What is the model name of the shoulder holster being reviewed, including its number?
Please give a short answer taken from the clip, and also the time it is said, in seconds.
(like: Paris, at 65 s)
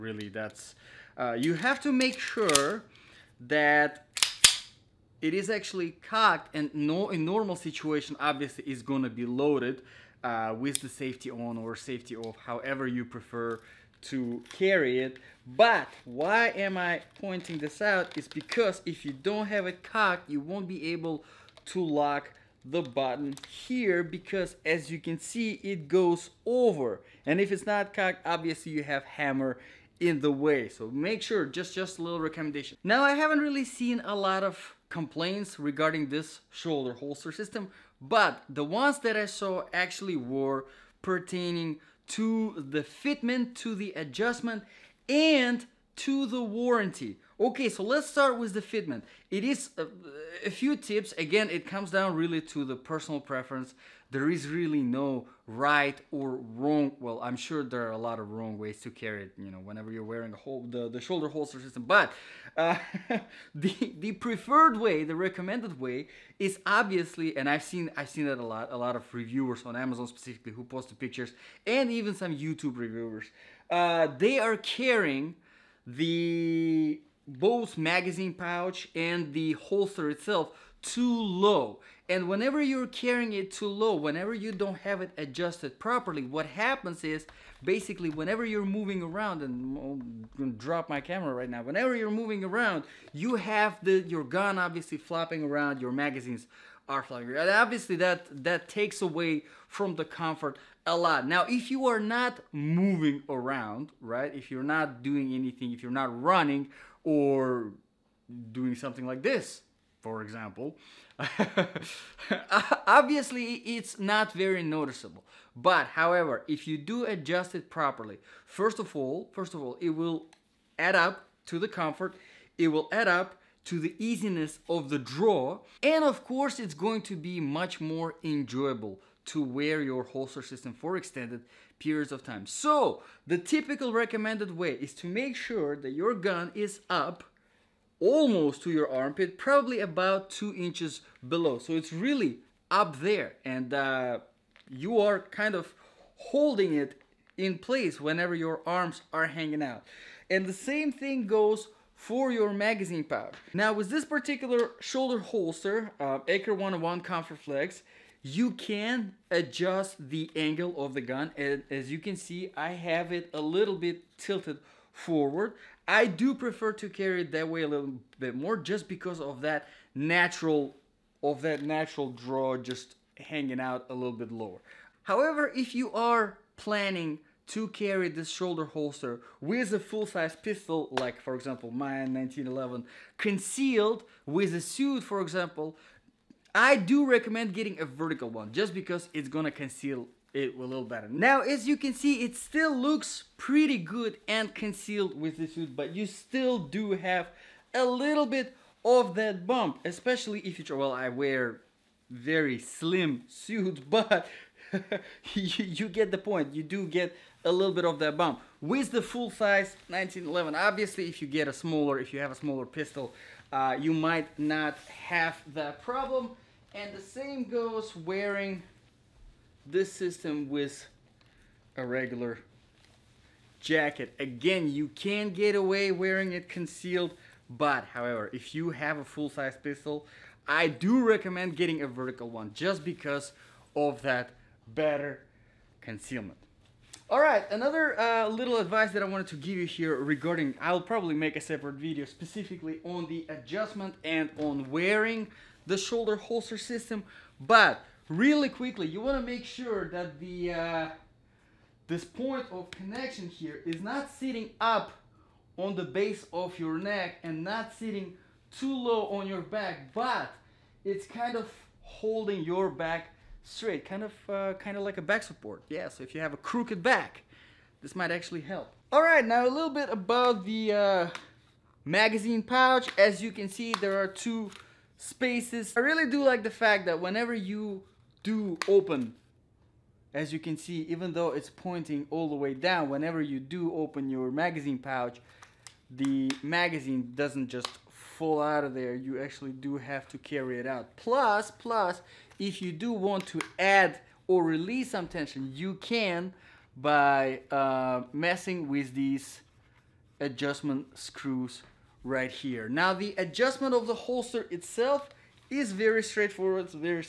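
Aker 101 Comfort Flex, at 156 s.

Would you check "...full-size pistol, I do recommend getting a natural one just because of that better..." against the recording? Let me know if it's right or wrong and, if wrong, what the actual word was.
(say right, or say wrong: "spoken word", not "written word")
wrong: "vertical", not "natural".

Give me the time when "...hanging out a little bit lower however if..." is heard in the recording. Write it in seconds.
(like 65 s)
173 s.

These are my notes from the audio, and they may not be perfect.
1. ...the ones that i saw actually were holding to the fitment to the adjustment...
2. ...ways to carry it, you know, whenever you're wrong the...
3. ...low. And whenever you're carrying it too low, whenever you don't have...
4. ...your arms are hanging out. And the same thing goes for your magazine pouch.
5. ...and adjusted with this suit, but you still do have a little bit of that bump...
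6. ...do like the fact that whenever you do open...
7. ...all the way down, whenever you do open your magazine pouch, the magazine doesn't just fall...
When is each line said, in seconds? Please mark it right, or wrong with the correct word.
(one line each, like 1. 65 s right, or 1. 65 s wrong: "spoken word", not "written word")
1. 38 s wrong: "pertaining", not "holding"
2. 58 s wrong: "wearing", not "wrong"
3. 81 s right
4. 148 s right
5. 194 s wrong: "concealed", not "adjusted"
6. 276 s right
7. 282 s right.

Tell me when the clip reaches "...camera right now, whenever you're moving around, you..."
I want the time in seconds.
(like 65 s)
91 s.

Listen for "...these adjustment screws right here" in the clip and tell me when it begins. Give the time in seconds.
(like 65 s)
298 s.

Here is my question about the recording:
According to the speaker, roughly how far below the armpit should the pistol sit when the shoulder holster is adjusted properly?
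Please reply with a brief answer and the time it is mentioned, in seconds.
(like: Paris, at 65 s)
2 inches, at 140 s.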